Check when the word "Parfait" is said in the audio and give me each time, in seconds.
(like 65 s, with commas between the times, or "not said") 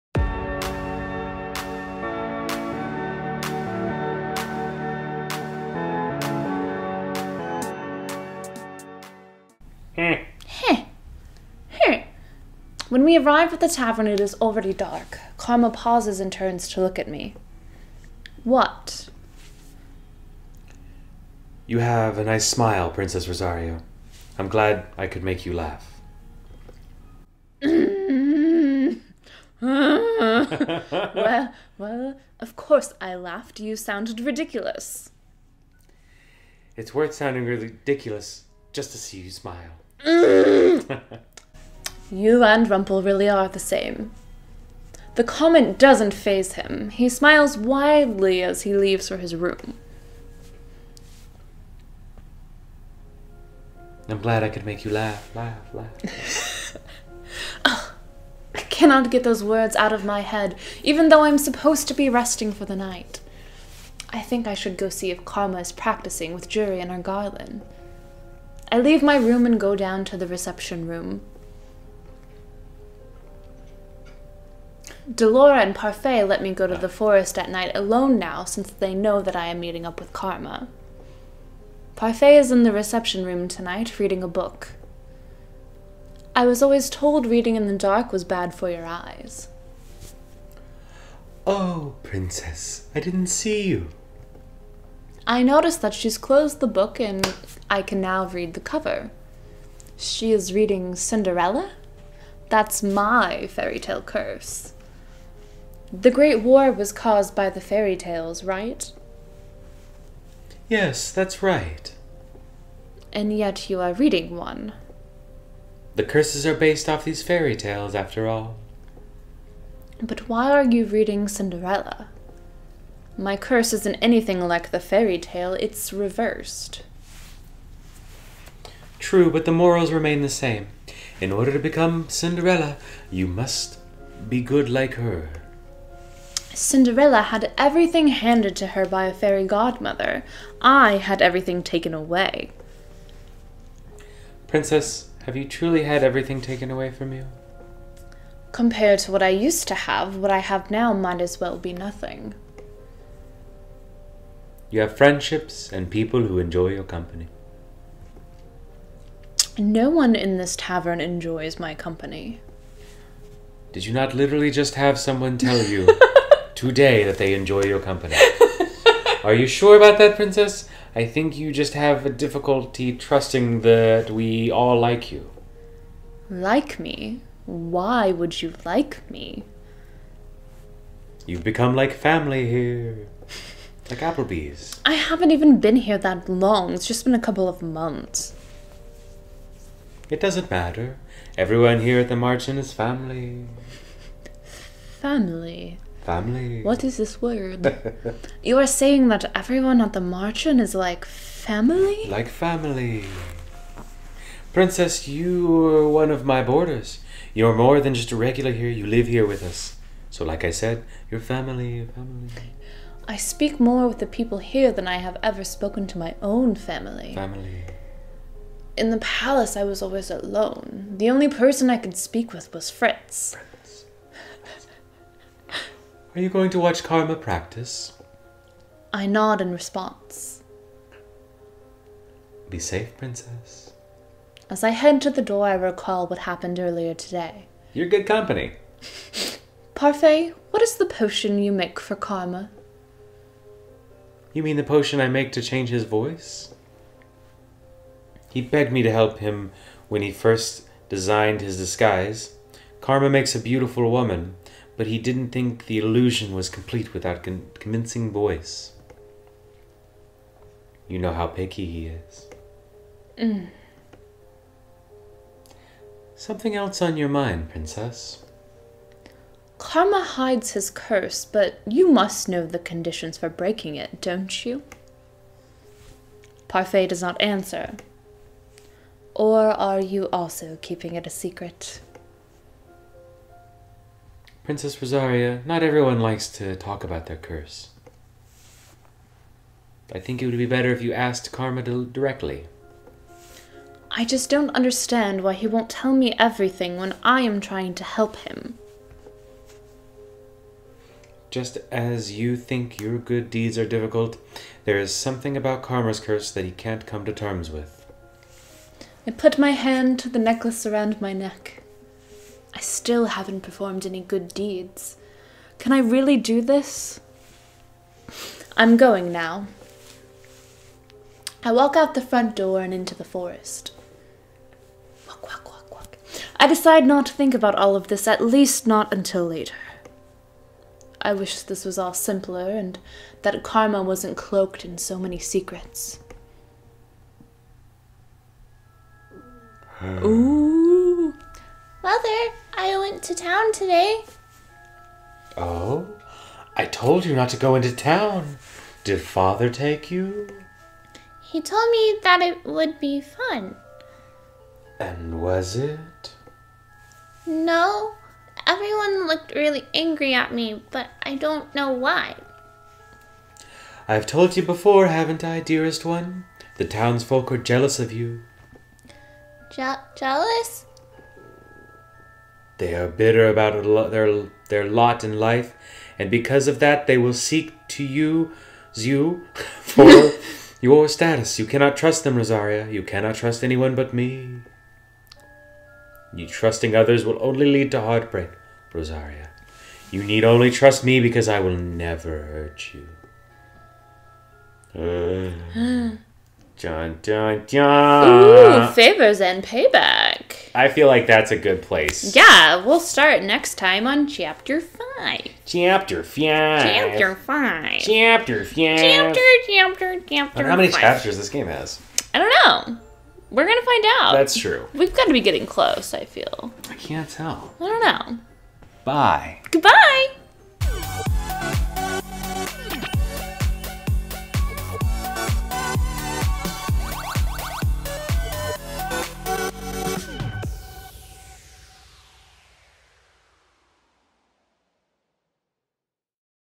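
75 s, 81 s, 239 s, 276 s.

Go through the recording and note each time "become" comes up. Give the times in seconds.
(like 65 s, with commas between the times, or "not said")
131 s, 181 s.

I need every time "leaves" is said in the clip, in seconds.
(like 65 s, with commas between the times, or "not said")
48 s, 68 s.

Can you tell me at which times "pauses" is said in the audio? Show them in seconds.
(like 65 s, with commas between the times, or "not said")
15 s.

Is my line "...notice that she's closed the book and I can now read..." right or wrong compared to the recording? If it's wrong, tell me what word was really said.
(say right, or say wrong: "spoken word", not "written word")
right.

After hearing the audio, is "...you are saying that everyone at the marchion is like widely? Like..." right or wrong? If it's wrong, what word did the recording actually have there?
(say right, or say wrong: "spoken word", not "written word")
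wrong: "family", not "widely".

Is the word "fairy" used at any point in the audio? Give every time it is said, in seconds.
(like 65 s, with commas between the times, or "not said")
103 s, 107 s, 117 s, 124 s, 139 s.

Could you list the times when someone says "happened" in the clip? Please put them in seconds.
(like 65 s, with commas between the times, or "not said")
236 s.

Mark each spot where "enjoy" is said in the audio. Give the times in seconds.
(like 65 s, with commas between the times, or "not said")
156 s, 160 s, 167 s.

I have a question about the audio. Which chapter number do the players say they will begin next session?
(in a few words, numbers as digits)
5.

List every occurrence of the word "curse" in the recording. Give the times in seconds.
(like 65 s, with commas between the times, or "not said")
104 s, 116 s, 123 s, 270 s, 287 s, 305 s.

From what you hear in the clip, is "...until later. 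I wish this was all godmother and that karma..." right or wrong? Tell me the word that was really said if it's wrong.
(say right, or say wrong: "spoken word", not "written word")
wrong: "simpler", not "godmother".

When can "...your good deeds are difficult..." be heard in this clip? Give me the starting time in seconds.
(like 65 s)
302 s.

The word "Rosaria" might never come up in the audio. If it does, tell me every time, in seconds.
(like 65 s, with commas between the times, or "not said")
23 s, 284 s, 382 s, 388 s.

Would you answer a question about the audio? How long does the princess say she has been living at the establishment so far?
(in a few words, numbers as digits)
A couple of months.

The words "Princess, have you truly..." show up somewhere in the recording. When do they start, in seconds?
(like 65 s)
144 s.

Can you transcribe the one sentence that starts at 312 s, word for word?
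I still haven't performed any good deeds.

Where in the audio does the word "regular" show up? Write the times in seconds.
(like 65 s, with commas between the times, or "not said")
208 s.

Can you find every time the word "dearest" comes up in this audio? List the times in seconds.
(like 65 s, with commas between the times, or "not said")
365 s.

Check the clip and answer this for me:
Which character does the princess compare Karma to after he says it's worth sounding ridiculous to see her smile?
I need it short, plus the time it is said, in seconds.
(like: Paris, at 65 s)
Rumple, at 42 s.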